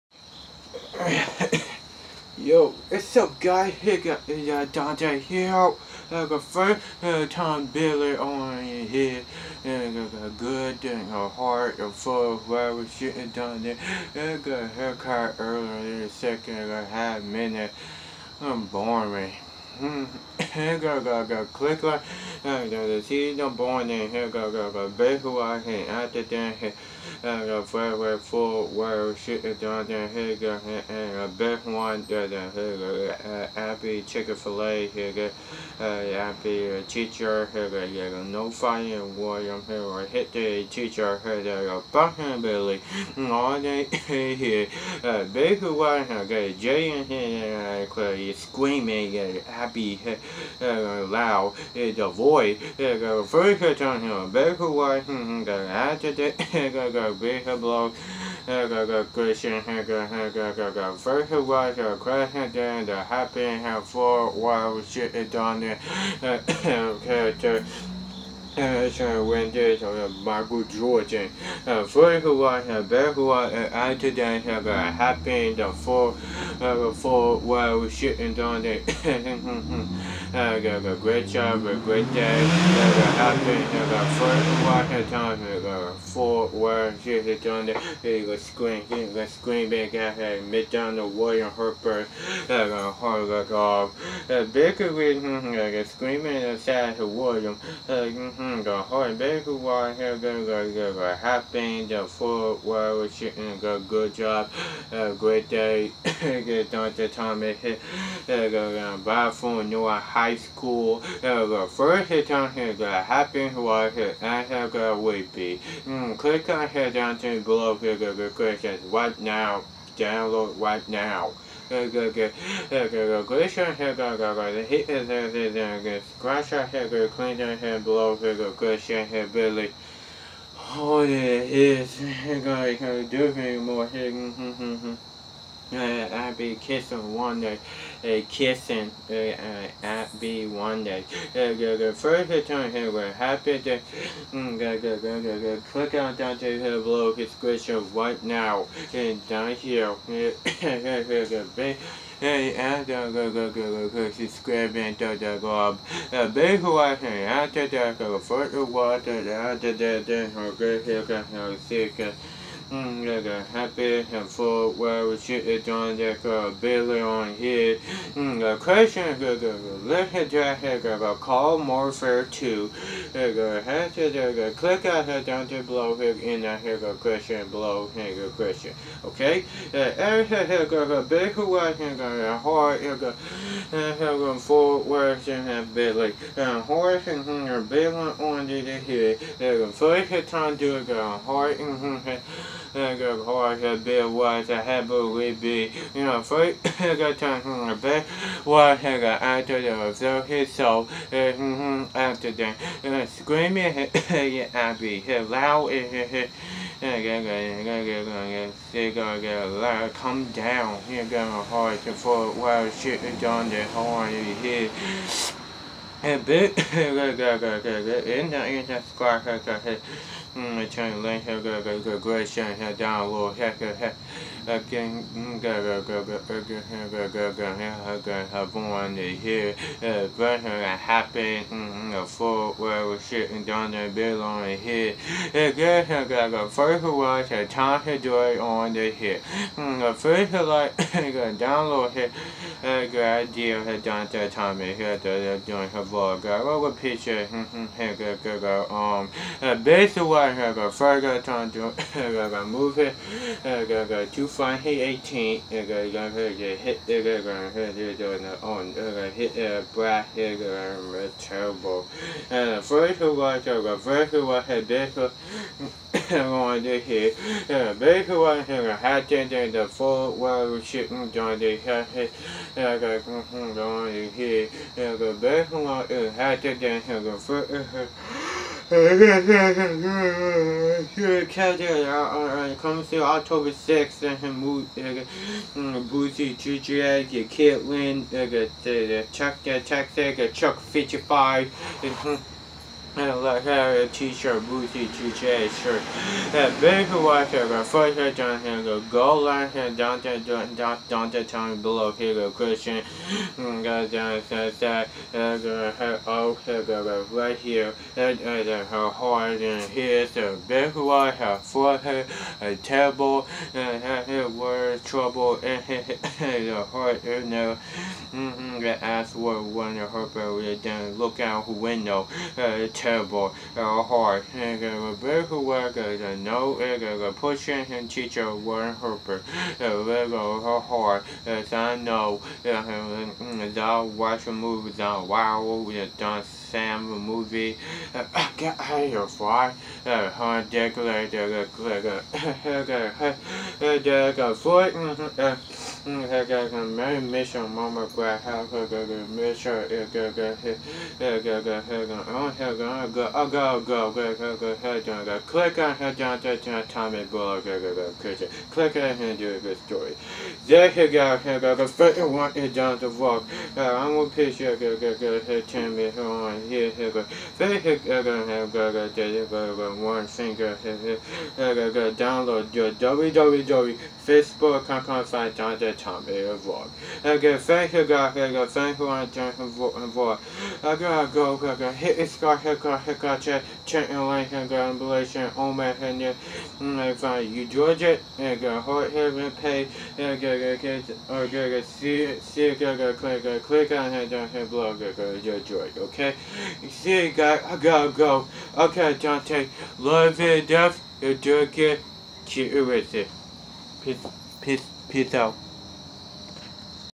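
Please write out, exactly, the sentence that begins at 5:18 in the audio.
Mm-hmm, the ass was one of her belly, then look out window, uh, terrible uh, hard.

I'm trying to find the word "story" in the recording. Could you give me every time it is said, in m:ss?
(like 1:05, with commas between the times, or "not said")
5:59.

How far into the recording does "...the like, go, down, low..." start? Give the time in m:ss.
4:00.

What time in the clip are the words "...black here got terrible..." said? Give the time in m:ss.
4:19.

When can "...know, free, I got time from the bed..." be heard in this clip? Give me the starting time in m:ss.
3:16.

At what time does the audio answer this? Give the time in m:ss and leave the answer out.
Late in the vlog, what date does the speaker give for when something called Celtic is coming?
4:43.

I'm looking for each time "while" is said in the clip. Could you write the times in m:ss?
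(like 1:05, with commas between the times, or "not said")
1:04, 1:17, 1:26, 1:39, 3:32.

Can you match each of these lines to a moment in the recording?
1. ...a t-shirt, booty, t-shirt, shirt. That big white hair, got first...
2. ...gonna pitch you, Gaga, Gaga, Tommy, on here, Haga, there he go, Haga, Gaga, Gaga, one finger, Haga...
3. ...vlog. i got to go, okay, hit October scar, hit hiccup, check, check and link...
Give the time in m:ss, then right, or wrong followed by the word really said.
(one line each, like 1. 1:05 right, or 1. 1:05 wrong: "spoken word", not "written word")
1. 4:53 right
2. 6:03 right
3. 6:19 wrong: "Hit", not "October".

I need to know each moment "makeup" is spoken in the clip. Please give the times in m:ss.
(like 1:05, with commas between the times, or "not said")
not said.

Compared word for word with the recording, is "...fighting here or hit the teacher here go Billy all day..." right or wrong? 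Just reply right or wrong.
right.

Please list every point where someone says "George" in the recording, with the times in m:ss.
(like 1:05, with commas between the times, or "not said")
6:27, 6:35.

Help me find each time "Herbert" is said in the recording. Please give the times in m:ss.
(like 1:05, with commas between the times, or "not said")
5:28.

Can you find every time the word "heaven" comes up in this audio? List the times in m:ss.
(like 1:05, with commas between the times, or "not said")
6:28.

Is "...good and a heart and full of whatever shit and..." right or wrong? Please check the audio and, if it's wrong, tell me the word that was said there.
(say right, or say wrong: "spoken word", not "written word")
right.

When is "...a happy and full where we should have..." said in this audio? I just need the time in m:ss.
2:43.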